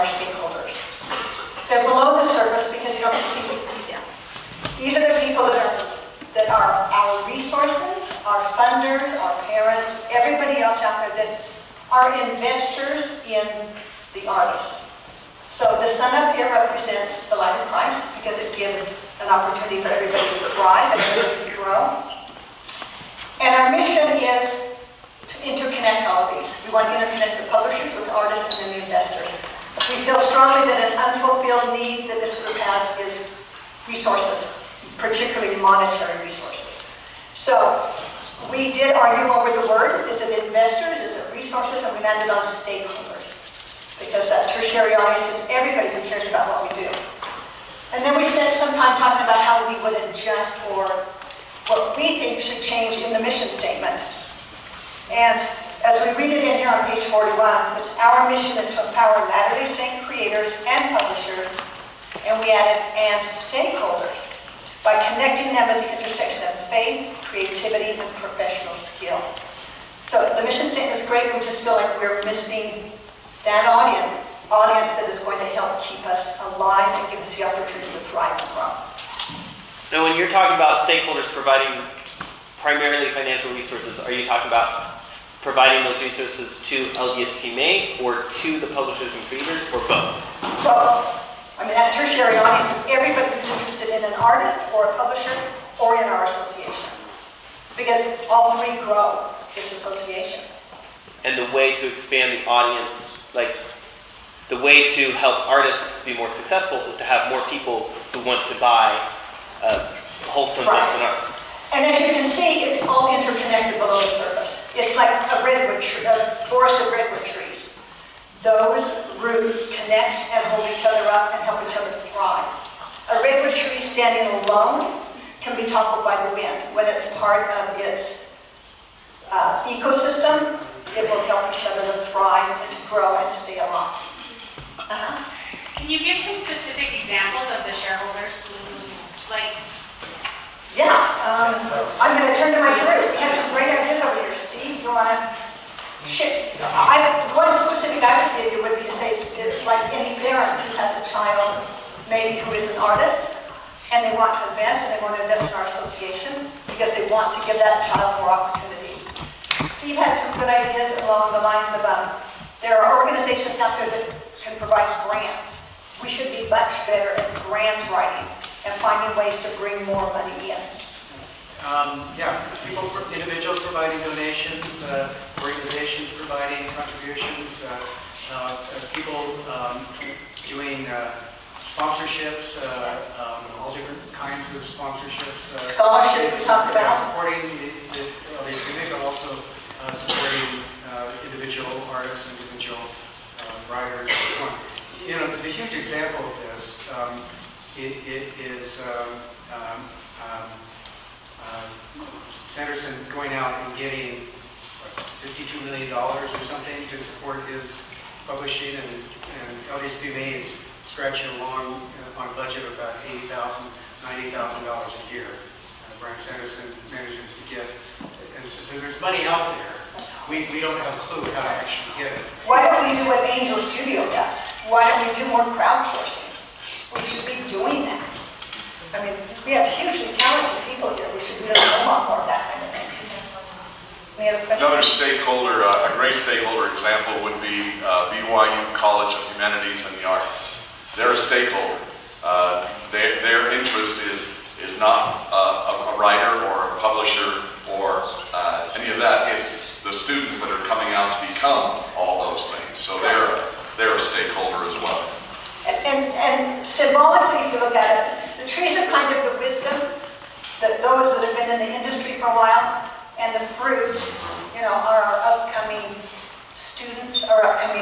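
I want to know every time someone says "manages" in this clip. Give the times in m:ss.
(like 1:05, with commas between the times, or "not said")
3:36.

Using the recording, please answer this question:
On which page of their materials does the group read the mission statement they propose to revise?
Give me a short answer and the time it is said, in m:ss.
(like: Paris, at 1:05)
41, at 0:56.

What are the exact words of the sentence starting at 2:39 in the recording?
Steve had some good ideas along the lines of um, there are organizations out there that can provide grants.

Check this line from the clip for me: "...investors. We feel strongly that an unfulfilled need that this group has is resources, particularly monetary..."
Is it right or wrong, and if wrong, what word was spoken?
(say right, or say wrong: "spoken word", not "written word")
right.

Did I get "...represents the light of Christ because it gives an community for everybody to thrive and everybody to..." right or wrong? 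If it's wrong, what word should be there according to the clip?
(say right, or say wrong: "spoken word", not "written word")
wrong: "opportunity", not "community".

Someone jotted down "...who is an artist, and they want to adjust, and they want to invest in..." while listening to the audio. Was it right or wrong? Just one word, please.
wrong.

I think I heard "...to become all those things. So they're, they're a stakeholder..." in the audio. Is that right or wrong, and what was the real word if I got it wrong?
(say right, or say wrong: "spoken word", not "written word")
right.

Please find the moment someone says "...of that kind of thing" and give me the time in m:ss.
3:52.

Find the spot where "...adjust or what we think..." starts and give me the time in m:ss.
0:50.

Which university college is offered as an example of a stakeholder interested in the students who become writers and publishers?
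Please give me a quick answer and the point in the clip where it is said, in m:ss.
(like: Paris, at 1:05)
BYU College of Humanities and the Arts, at 3:58.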